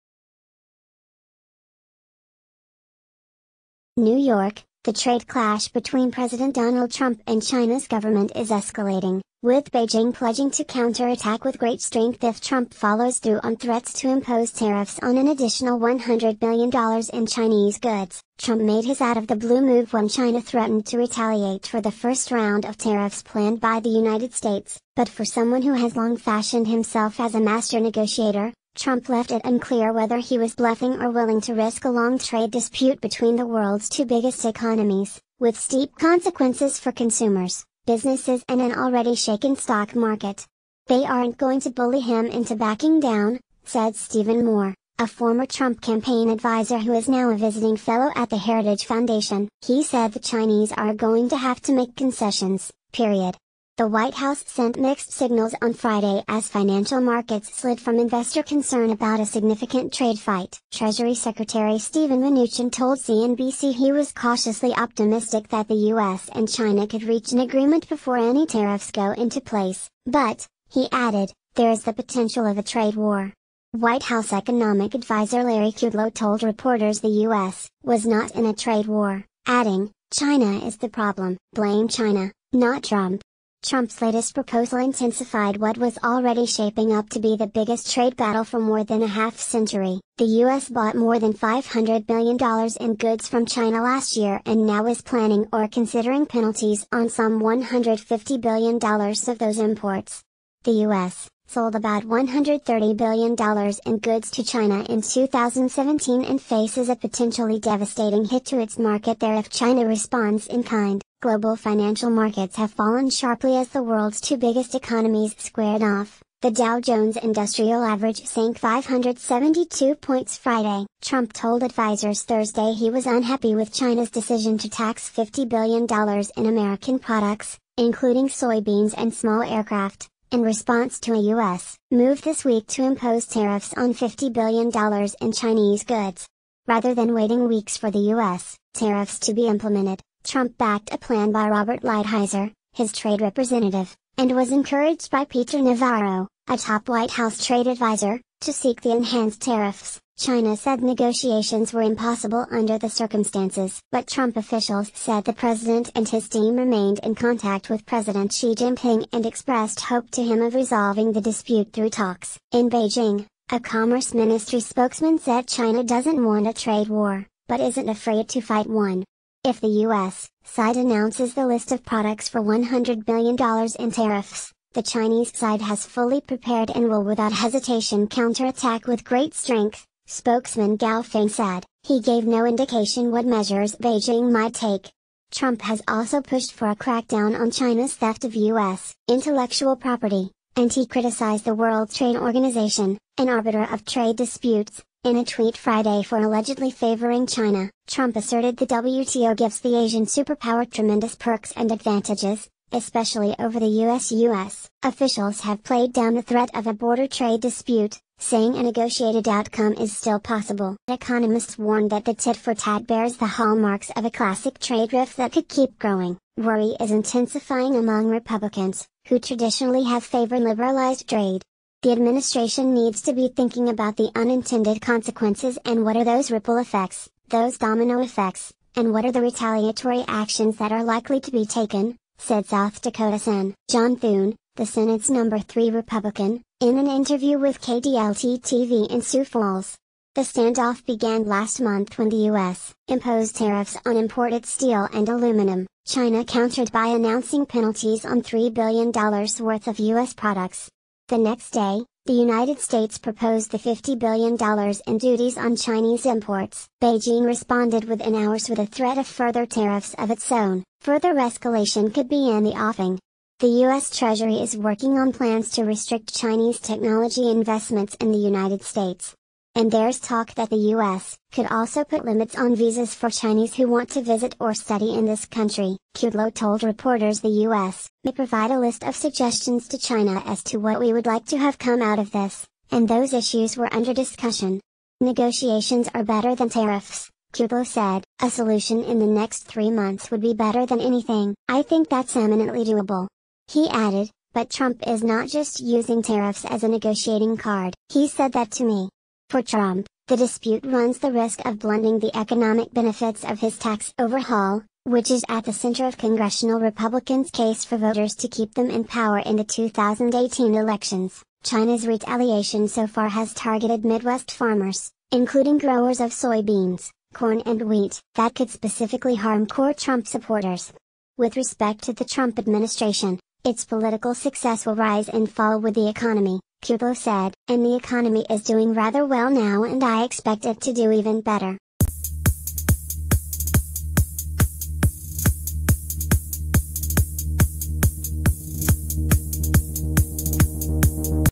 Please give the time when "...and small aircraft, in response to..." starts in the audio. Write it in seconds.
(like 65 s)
128 s.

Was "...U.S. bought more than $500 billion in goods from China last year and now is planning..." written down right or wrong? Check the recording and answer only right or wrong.
right.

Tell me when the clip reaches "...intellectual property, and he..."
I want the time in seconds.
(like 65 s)
189 s.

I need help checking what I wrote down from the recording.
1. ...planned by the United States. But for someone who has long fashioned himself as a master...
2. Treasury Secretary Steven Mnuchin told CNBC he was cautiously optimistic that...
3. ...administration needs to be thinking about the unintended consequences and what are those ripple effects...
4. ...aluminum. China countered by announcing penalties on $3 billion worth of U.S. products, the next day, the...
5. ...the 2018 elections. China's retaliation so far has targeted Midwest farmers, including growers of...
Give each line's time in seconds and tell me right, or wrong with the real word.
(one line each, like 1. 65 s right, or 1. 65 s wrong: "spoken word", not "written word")
1. 23 s right
2. 60 s right
3. 221 s right
4. 245 s right
5. 309 s right.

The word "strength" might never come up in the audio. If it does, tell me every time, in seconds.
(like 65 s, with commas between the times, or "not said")
11 s, 179 s.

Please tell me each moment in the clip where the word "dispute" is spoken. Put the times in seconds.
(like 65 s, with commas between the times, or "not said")
32 s, 161 s, 194 s, 207 s, 300 s.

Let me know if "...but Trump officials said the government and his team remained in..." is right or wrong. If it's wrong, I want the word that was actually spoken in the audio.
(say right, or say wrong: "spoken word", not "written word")
wrong: "president", not "government".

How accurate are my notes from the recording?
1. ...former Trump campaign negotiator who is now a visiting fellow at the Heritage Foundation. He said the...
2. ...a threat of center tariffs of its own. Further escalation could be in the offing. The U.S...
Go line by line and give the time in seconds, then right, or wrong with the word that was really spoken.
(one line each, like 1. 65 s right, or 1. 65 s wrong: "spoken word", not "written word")
1. 45 s wrong: "advisor", not "negotiator"
2. 258 s wrong: "further", not "center".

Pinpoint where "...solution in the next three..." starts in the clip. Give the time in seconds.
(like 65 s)
288 s.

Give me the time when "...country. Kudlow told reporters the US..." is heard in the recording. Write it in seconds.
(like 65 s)
275 s.